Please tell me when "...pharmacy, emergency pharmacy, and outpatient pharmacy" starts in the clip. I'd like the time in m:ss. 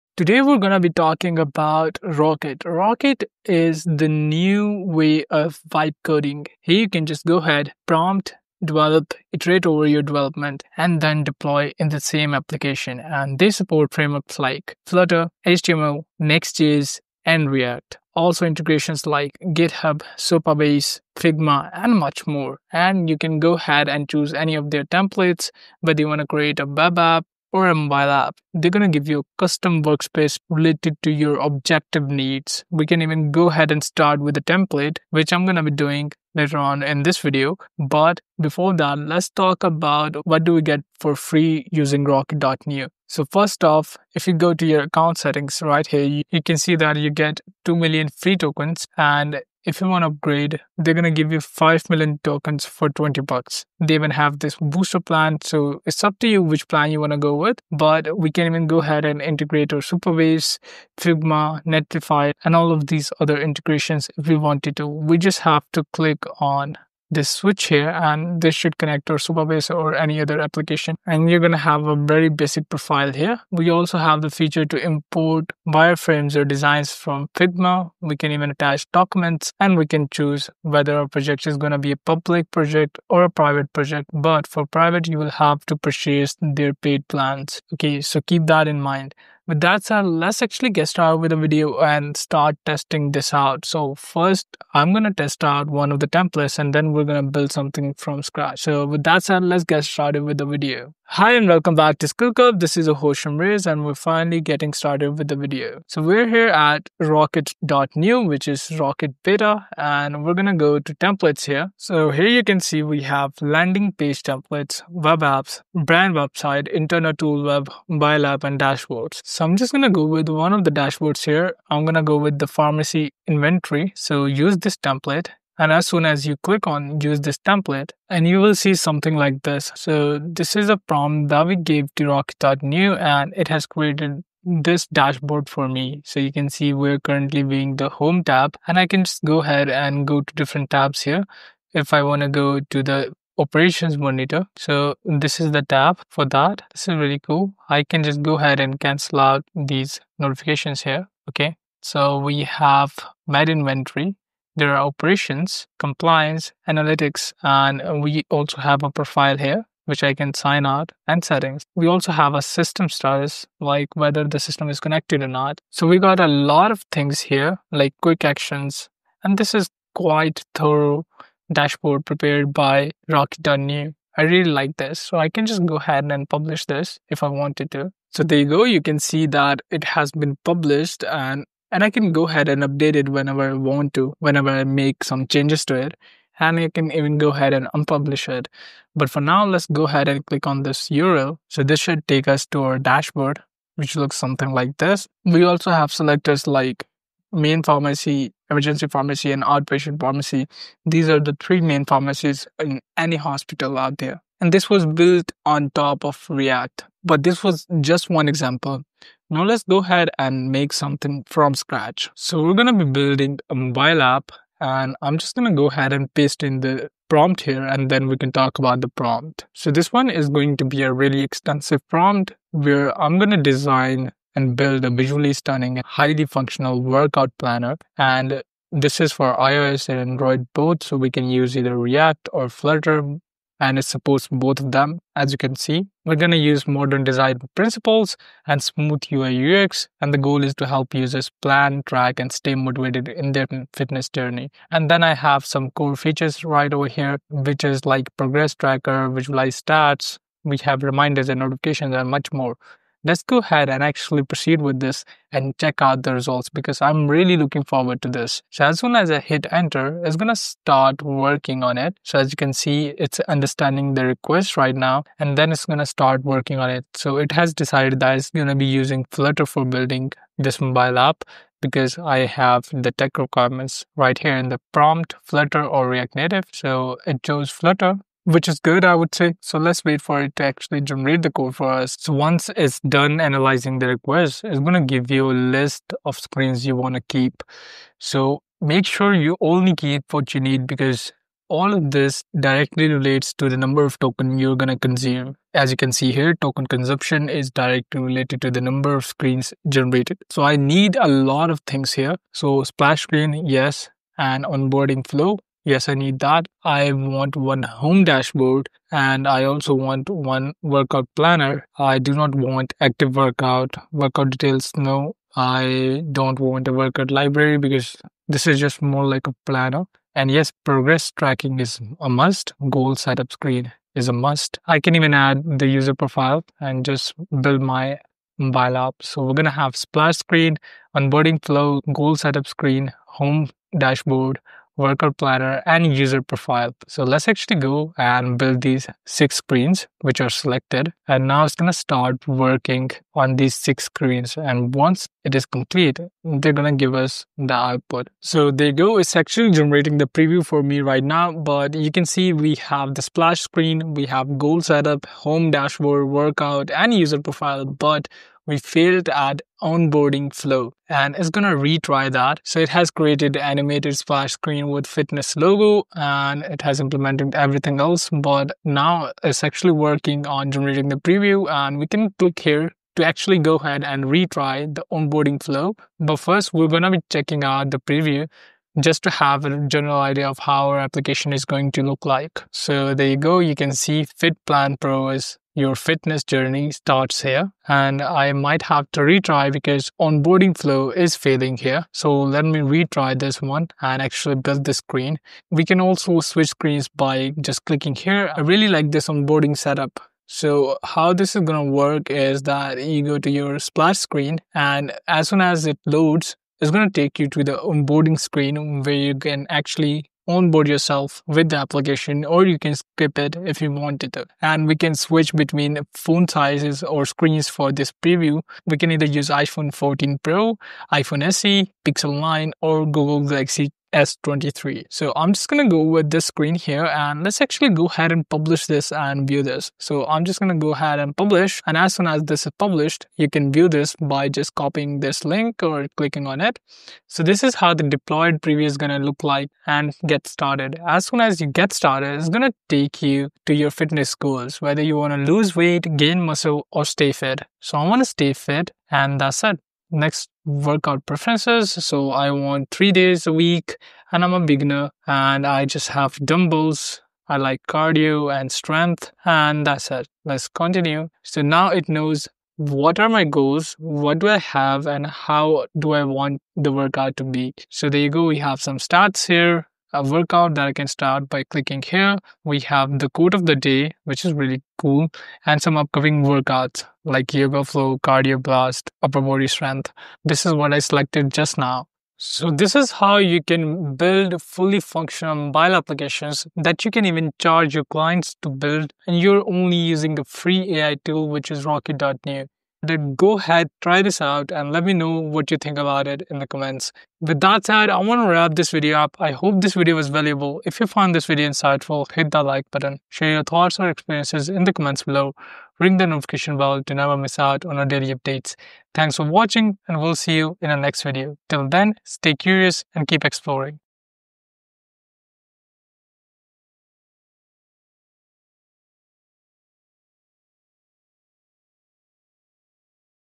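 3:17.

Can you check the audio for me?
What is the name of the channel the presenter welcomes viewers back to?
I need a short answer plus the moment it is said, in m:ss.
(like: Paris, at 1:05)
SkillCurb, at 1:42.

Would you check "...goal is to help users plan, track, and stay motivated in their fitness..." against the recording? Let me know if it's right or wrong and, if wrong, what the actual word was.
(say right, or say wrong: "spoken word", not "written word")
right.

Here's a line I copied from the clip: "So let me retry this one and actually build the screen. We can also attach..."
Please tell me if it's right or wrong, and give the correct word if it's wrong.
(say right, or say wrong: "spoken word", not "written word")
wrong: "switch", not "attach".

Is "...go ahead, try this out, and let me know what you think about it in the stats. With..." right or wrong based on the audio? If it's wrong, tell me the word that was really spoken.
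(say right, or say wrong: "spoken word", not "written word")
wrong: "comments", not "stats".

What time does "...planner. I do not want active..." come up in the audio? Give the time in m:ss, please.
5:11.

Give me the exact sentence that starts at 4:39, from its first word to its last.
So let's wait for it to actually generate the code for us.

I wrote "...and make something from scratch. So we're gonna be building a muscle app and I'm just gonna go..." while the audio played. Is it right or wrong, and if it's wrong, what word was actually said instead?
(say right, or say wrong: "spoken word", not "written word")
wrong: "mobile", not "muscle".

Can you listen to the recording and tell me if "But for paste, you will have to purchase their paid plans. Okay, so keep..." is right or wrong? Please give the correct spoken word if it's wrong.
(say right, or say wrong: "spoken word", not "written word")
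wrong: "private", not "paste".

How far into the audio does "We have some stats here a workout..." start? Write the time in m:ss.
7:48.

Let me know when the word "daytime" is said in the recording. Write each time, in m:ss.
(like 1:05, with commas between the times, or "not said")
not said.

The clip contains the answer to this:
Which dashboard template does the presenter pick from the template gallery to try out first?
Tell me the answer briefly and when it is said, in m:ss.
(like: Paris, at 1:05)
Pharmacy inventory, at 2:02.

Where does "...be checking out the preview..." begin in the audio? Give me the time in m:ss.
6:16.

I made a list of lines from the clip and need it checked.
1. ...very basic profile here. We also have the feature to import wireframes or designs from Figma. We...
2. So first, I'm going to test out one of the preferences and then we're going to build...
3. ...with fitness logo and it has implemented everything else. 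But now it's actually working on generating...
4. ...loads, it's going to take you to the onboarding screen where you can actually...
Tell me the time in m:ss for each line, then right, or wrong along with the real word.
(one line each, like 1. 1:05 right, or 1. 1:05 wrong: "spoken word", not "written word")
1. 1:11 right
2. 1:33 wrong: "templates", not "preferences"
3. 6:04 right
4. 6:45 right.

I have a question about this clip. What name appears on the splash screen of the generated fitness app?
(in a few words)
Fit Plan Pro.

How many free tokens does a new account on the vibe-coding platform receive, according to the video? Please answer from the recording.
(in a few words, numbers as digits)
2 million.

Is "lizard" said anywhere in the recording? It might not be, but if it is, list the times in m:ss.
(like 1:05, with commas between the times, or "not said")
not said.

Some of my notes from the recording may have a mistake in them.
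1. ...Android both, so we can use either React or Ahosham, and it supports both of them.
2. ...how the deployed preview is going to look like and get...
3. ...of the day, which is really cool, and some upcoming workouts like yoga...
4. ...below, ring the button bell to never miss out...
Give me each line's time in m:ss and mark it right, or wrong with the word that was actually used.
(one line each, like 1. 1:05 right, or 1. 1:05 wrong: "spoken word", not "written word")
1. 3:49 wrong: "Flutter", not "Ahosham"
2. 7:17 right
3. 7:53 right
4. 8:25 wrong: "notification", not "button".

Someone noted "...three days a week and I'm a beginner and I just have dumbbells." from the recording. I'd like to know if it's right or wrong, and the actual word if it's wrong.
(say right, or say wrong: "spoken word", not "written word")
right.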